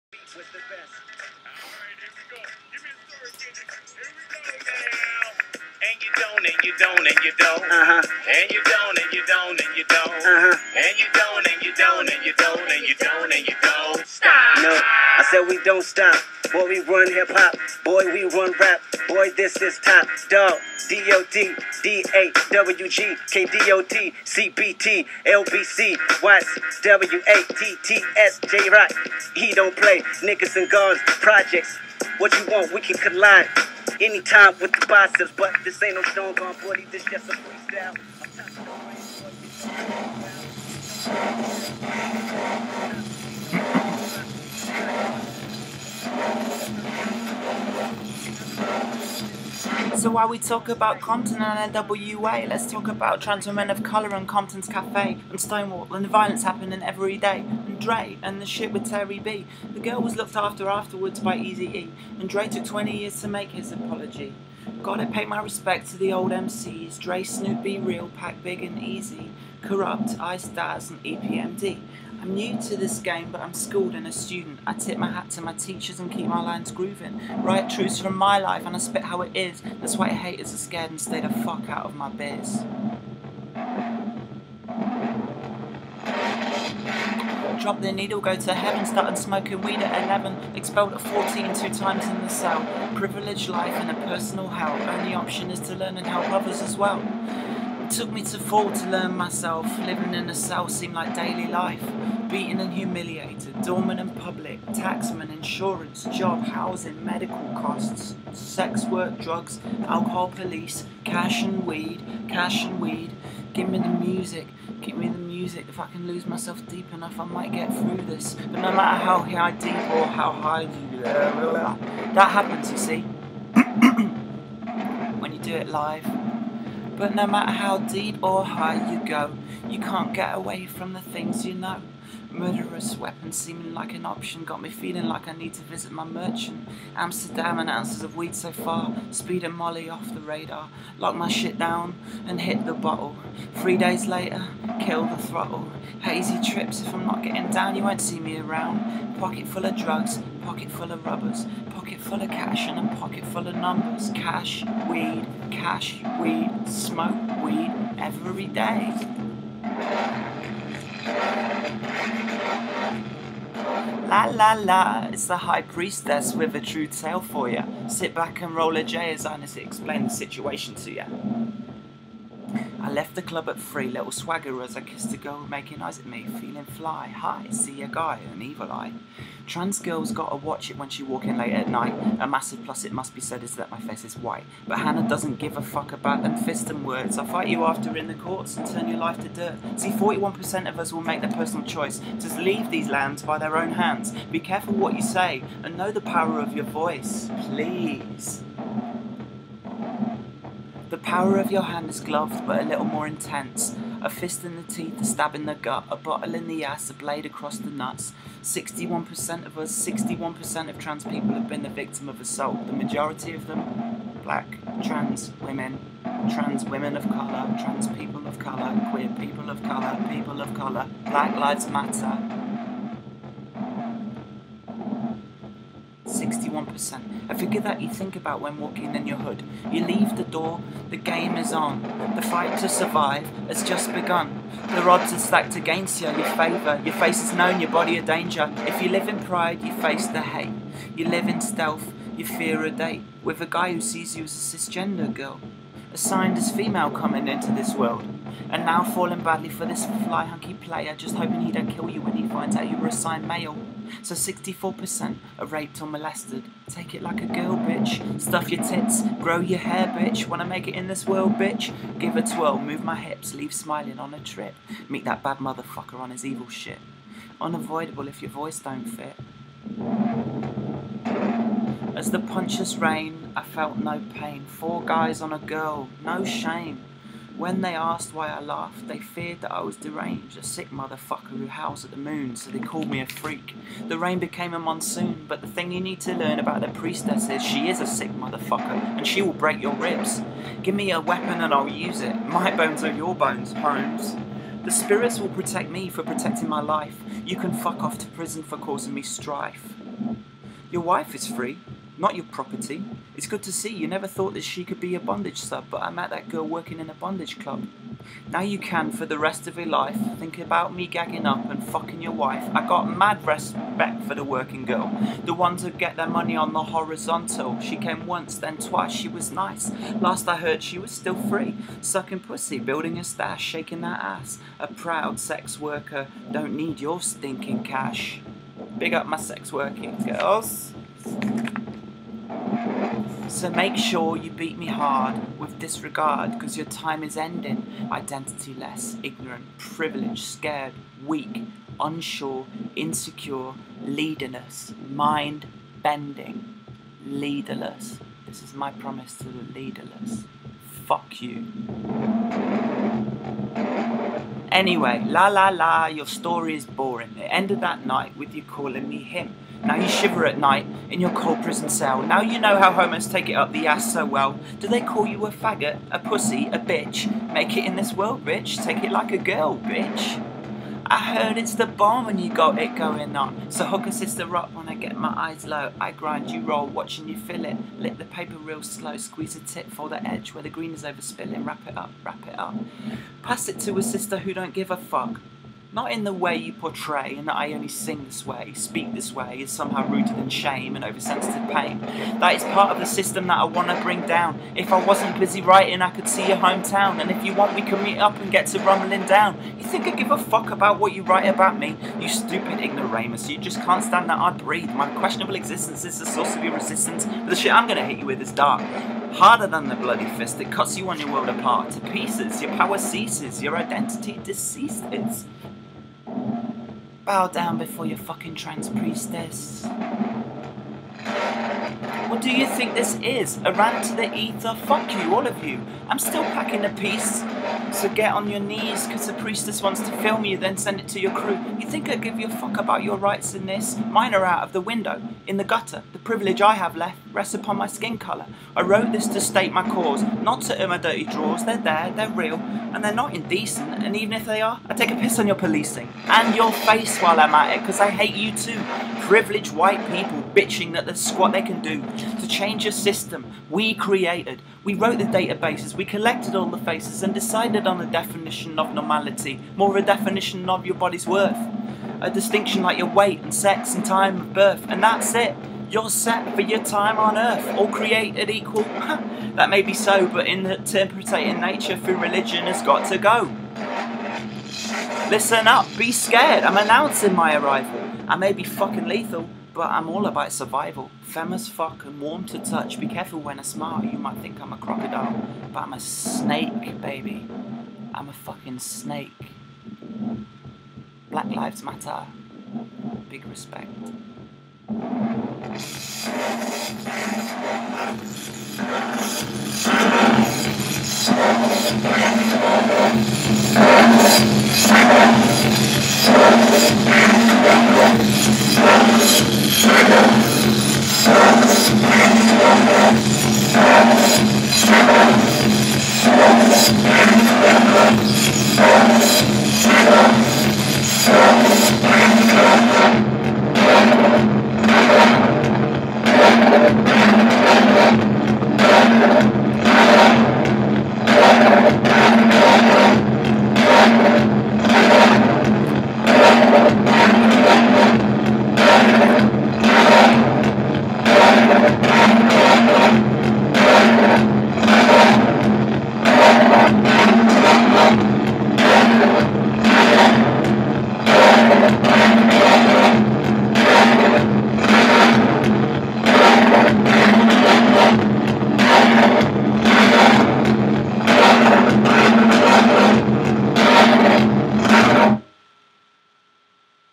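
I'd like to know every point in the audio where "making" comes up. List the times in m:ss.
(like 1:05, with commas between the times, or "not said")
2:55.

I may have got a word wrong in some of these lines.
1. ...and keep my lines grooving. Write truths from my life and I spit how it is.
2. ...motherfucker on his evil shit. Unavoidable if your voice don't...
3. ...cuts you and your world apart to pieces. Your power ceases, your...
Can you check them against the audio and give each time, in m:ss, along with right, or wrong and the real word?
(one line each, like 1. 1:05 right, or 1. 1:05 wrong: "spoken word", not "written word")
1. 1:15 right
2. 4:25 right
3. 6:50 right.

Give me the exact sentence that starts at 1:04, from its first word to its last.
Gotta pay my respects to the old MCs, Dre, Snoop, Be Real, Pac Big and Easy.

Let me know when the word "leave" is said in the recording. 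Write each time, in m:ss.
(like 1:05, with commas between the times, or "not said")
3:12, 3:49, 4:23.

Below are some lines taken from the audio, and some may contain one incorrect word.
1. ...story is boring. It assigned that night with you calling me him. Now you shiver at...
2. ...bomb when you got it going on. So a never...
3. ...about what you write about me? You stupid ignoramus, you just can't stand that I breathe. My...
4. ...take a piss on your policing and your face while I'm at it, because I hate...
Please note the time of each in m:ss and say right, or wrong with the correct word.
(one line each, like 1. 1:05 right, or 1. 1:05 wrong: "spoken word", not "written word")
1. 5:56 wrong: "ended", not "assigned"
2. 6:11 wrong: "sister", not "never"
3. 6:40 right
4. 7:24 right.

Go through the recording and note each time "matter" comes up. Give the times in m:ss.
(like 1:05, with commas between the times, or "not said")
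1:58, 2:07, 3:41, 8:11.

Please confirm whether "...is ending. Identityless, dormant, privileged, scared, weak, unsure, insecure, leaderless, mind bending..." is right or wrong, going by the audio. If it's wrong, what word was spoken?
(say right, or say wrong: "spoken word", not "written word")
wrong: "ignorant", not "dormant".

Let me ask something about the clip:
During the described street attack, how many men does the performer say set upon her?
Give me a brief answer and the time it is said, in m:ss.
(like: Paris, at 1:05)
4, at 4:34.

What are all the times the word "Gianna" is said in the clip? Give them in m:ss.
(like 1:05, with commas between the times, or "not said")
not said.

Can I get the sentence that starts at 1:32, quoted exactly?
Privileged life and a personal hell, only option is to learn and help others as well.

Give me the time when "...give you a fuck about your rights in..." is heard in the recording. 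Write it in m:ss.
7:11.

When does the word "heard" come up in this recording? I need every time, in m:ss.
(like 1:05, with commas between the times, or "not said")
5:20, 6:11.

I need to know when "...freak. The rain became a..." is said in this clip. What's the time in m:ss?
4:43.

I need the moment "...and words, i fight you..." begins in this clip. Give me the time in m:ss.
3:06.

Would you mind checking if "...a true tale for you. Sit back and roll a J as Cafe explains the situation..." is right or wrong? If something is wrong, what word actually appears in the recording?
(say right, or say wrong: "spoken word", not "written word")
wrong: "Ines", not "Cafe".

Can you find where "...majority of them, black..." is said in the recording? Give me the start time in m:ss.
3:32.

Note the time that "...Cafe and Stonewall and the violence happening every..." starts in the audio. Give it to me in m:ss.
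0:54.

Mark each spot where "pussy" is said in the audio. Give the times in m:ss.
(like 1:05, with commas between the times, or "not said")
5:22, 6:05.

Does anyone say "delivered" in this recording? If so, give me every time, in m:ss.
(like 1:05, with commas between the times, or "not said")
not said.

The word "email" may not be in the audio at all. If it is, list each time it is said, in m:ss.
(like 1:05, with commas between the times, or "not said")
not said.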